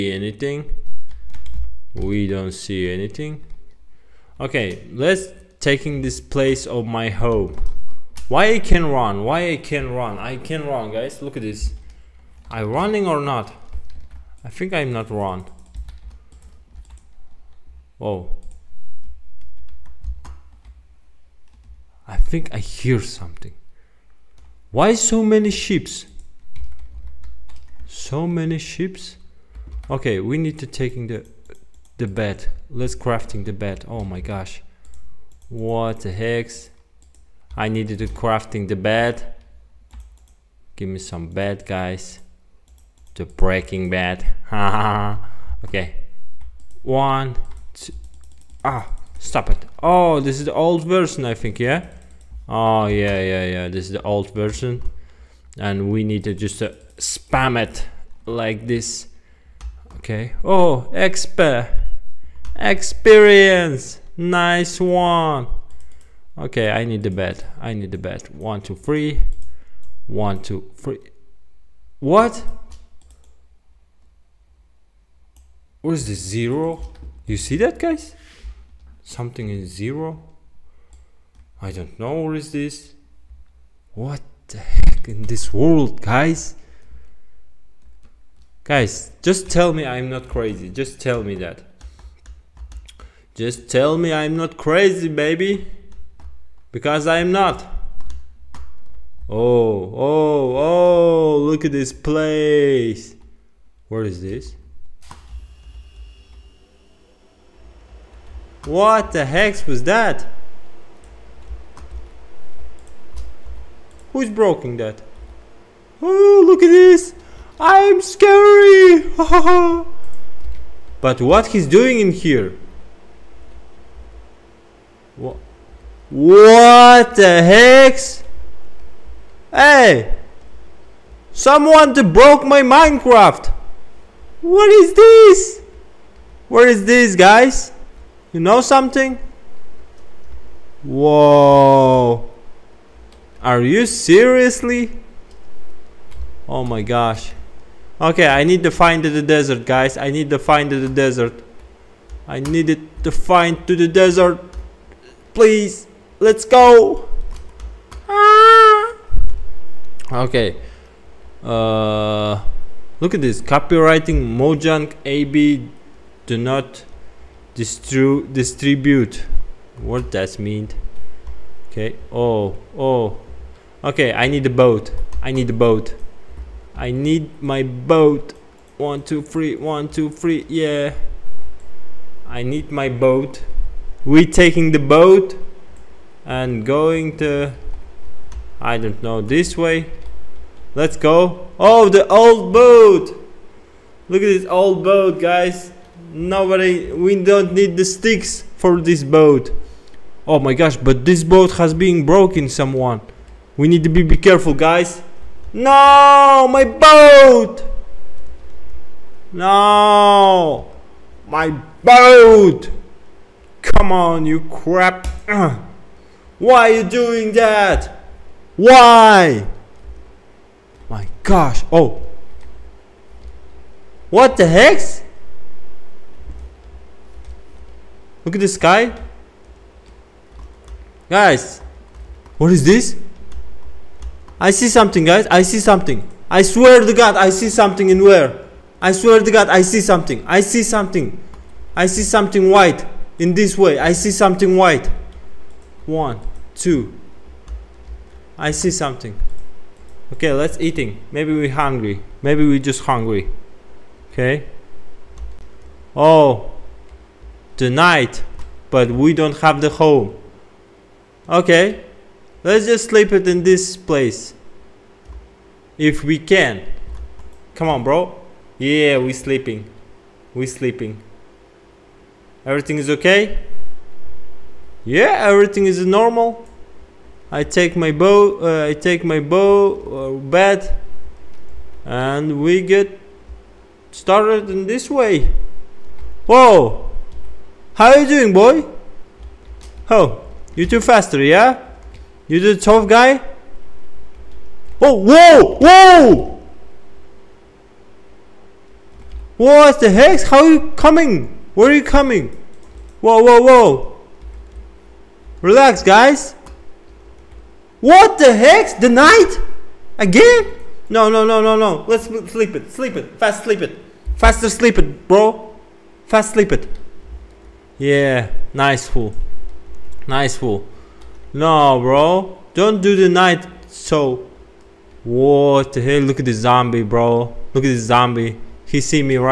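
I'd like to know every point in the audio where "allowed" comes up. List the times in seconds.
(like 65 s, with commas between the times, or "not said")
not said.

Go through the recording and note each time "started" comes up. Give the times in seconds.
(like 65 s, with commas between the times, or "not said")
283 s.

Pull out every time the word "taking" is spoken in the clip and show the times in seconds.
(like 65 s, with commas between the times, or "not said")
5 s, 30 s, 184 s.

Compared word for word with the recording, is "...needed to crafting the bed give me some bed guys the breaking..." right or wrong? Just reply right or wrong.
right.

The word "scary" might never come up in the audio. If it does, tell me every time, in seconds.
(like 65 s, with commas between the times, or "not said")
118 s.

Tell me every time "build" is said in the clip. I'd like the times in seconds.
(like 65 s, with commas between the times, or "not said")
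not said.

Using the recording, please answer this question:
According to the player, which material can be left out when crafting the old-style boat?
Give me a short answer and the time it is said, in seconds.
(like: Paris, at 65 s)
sticks, at 197 s.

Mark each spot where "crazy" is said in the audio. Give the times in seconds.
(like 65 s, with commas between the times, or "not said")
90 s, 94 s.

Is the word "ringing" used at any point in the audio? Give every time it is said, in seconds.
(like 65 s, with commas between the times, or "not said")
not said.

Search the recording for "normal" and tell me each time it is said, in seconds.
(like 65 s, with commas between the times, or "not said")
275 s.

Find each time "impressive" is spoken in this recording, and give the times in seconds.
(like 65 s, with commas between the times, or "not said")
not said.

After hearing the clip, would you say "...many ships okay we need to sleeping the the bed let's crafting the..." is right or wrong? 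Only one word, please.
wrong.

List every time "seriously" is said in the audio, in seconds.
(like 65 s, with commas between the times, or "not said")
143 s.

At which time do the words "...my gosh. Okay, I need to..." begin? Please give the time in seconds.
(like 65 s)
146 s.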